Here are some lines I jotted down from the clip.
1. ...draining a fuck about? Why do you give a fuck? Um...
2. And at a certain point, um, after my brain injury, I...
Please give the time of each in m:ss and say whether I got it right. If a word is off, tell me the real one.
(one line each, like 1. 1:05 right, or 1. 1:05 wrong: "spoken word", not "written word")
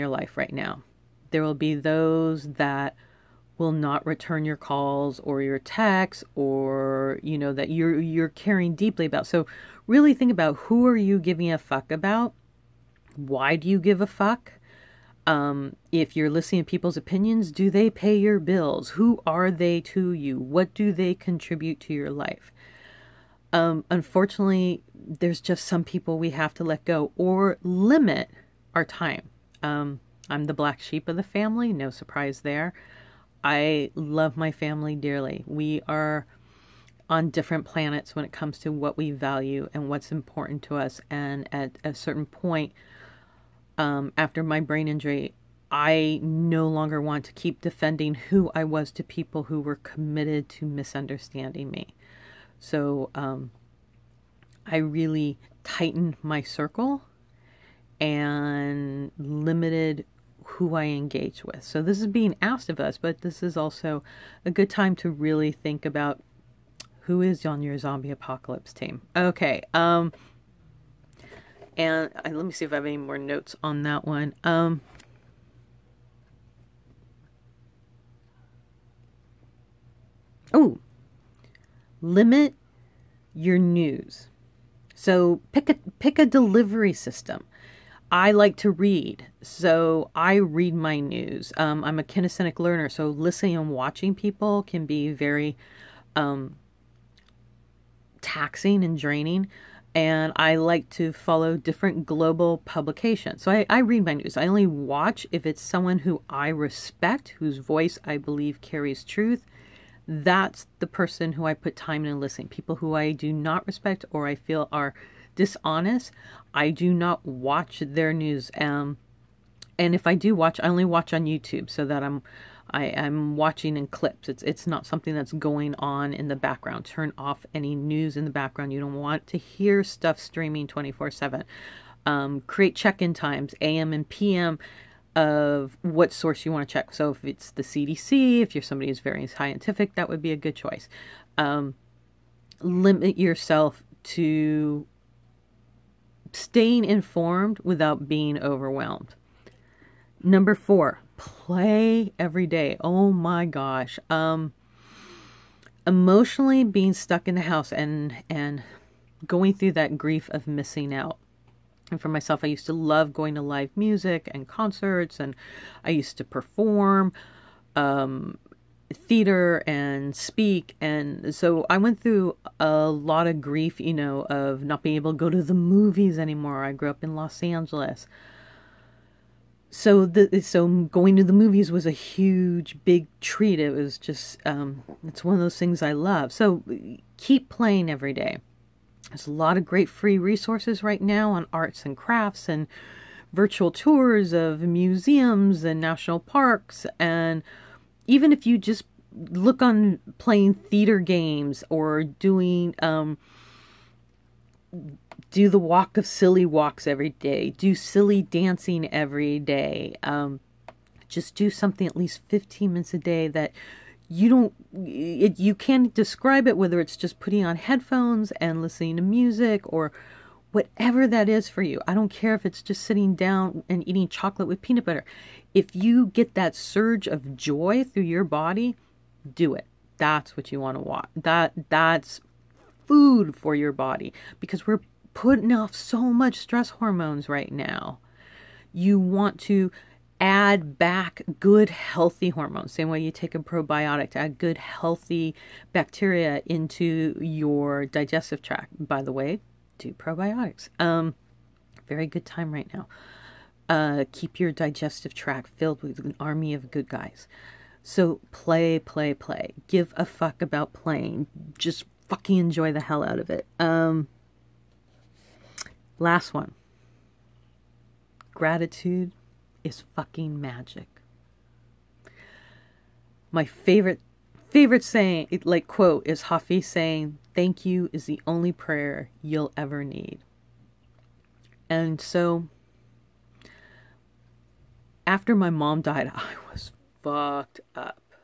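1. 0:11 wrong: "giving", not "draining"
2. 0:41 right.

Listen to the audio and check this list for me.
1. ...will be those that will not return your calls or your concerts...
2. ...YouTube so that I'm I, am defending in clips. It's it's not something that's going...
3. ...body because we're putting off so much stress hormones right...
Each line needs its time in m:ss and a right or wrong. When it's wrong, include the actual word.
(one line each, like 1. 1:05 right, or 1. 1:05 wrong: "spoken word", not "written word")
1. 0:01 wrong: "texts", not "concerts"
2. 2:01 wrong: "watching", not "defending"
3. 3:53 right.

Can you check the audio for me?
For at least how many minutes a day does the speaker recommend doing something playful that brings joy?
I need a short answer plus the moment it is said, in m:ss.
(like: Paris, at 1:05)
15, at 3:32.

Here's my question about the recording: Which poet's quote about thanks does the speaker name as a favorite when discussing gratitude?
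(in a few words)
Hafiz.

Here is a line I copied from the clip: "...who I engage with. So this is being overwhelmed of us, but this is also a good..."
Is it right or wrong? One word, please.
wrong.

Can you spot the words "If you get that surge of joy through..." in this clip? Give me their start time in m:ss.
3:45.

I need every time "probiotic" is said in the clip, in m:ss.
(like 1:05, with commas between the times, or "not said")
4:03, 4:09.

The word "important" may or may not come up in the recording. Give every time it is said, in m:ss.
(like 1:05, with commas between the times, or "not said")
0:40.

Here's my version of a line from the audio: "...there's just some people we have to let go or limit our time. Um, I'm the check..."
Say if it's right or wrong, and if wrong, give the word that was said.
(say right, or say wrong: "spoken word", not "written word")
wrong: "black", not "check".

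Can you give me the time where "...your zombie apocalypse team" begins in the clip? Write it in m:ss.
1:07.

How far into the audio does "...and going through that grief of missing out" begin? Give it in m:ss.
2:38.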